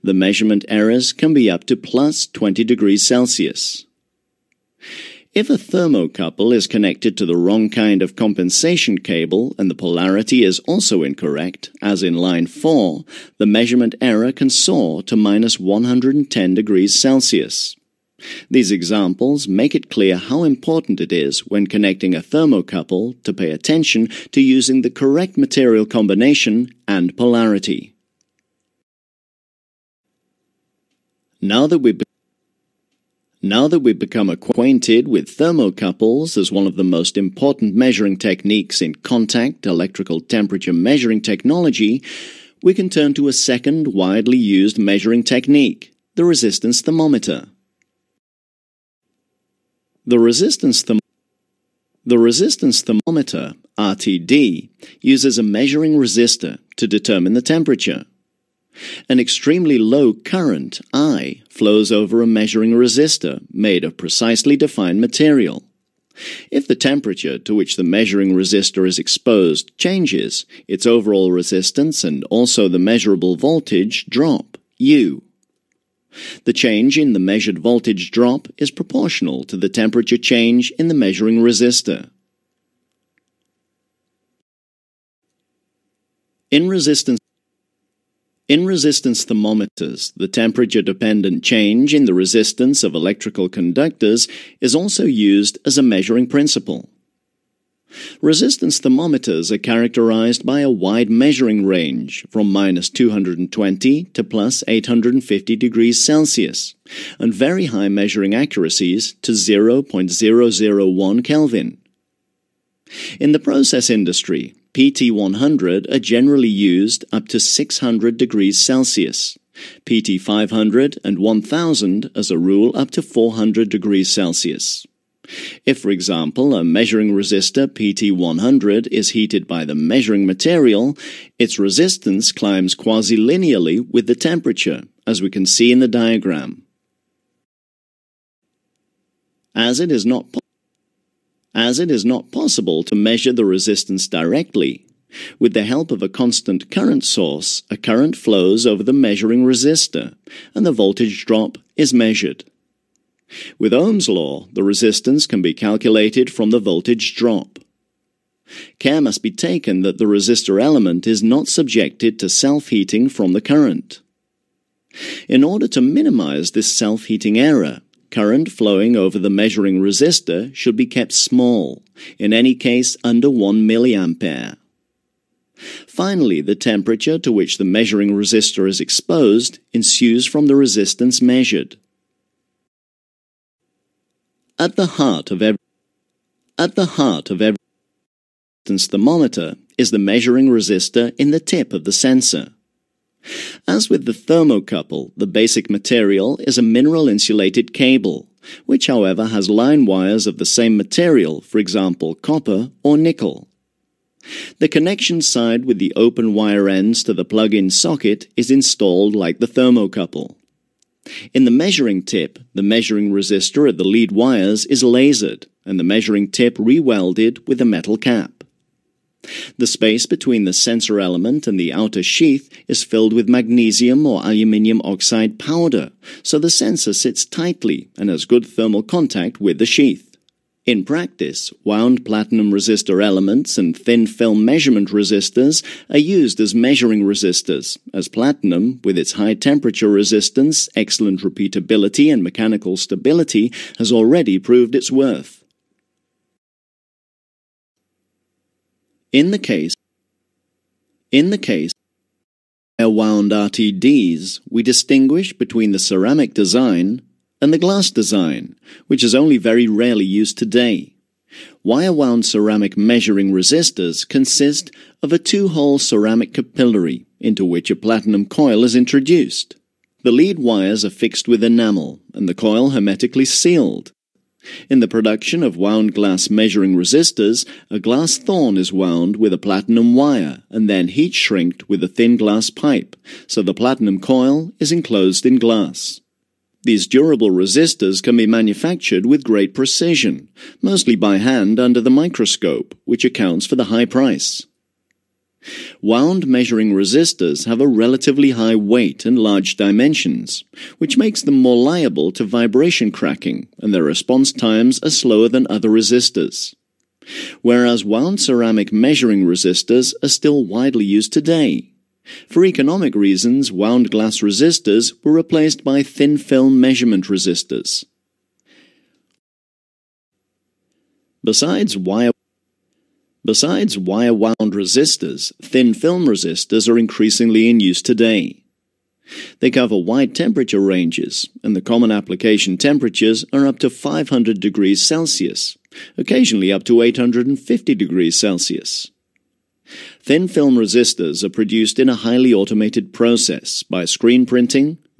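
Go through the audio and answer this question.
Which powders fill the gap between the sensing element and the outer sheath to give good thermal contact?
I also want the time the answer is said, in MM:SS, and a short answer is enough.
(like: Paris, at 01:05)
magnesium or aluminium oxide, at 03:43.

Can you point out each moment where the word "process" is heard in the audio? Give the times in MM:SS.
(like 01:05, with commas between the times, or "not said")
01:53, 05:42.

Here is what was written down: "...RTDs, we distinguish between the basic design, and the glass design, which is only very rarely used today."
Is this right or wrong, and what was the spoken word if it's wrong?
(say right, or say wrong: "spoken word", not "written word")
wrong: "ceramic", not "basic".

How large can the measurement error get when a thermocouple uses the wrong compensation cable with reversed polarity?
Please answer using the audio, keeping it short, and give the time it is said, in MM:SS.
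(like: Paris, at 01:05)
-110 degrees Celsius, at 00:15.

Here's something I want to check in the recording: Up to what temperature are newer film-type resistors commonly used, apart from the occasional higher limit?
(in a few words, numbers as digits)
500 degrees Celsius.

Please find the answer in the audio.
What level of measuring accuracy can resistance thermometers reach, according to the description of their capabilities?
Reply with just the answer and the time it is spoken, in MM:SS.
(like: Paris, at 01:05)
0.001 Kelvin, at 01:49.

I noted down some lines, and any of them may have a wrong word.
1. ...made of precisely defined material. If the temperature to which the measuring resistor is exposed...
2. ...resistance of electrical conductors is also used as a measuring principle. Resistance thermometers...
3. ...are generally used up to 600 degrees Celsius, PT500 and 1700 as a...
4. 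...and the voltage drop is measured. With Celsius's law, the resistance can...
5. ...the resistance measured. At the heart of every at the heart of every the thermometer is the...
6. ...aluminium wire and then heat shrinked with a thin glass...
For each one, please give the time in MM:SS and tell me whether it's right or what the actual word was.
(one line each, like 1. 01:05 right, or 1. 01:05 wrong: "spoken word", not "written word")
1. 01:03 right
2. 01:32 right
3. 01:55 wrong: "1000", not "1700"
4. 02:30 wrong: "Ohm", not "Celsius"
5. 03:00 right
6. 04:39 wrong: "platinum", not "aluminium".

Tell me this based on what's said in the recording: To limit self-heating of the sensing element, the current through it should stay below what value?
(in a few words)
1 milliampere.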